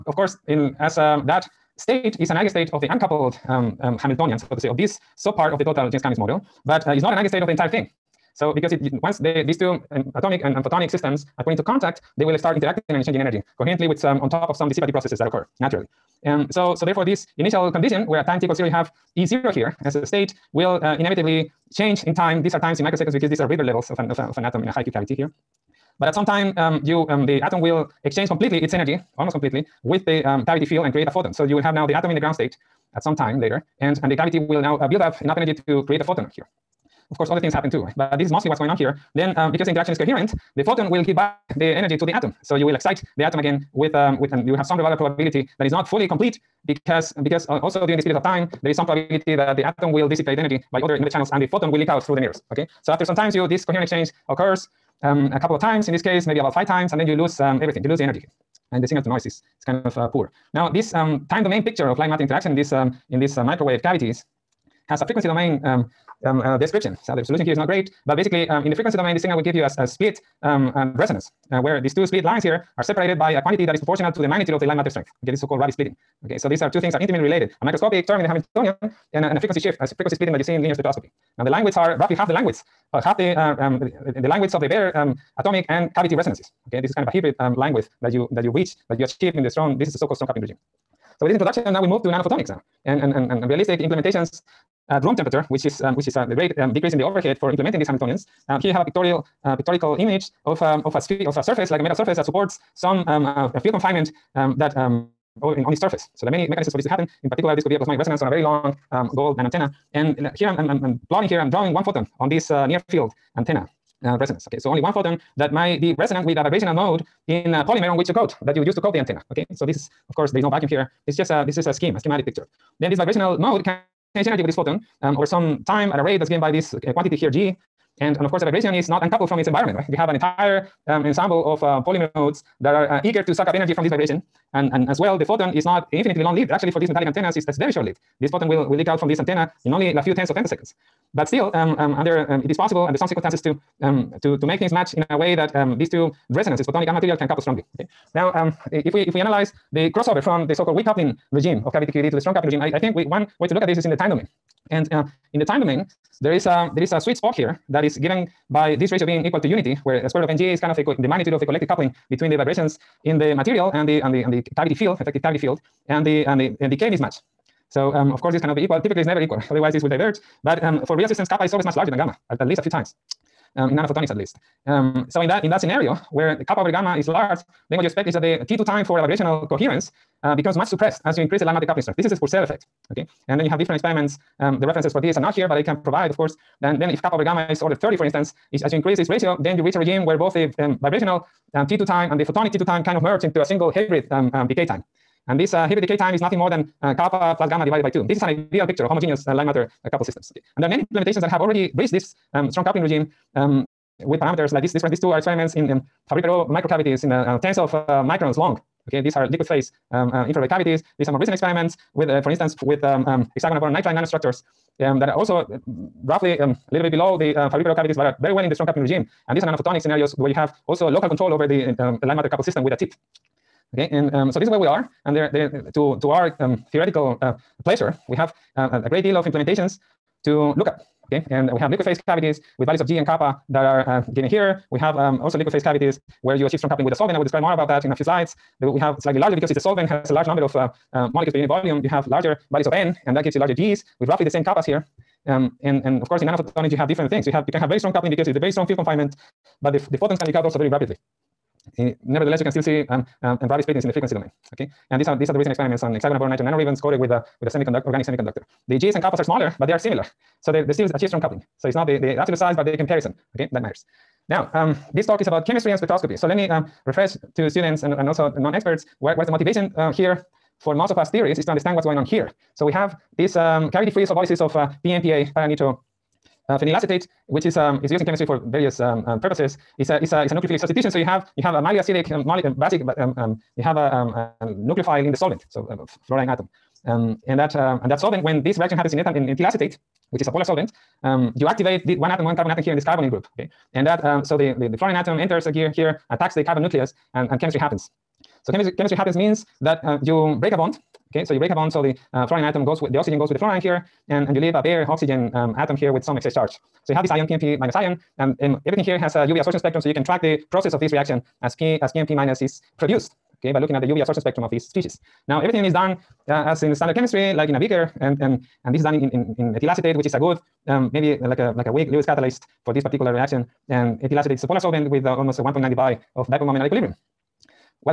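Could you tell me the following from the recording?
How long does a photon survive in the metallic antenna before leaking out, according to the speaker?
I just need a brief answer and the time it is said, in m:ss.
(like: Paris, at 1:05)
a few tens of femtoseconds, at 2:19.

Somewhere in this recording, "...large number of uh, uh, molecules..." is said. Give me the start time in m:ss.
4:00.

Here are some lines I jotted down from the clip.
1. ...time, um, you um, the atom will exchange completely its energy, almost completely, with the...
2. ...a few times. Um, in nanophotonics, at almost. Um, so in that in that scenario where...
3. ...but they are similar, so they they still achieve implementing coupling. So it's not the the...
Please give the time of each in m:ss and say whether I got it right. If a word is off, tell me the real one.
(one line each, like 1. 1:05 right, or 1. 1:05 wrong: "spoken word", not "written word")
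1. 0:26 right
2. 2:52 wrong: "least", not "almost"
3. 4:19 wrong: "strong", not "implementing".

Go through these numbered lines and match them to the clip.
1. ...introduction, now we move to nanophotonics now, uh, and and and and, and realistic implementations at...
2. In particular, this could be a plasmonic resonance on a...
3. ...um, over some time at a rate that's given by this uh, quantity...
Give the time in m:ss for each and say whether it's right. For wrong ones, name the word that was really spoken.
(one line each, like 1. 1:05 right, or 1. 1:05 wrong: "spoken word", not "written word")
1. 1:31 right
2. 1:47 right
3. 2:05 right.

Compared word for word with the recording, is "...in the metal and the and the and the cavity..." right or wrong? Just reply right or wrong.
wrong.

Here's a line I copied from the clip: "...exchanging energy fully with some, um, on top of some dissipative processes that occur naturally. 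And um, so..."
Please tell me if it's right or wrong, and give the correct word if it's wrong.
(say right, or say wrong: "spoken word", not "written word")
wrong: "coherently", not "fully".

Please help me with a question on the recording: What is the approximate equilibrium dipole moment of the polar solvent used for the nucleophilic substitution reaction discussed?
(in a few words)
1.9 debye.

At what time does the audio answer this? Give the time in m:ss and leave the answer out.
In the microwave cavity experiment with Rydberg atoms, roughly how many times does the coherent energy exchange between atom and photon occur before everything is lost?
0:56.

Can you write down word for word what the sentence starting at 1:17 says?
A microscopic term in the Hamiltonian and a, and a frequency shift, a frequency splitting that you see in linear spectroscopy.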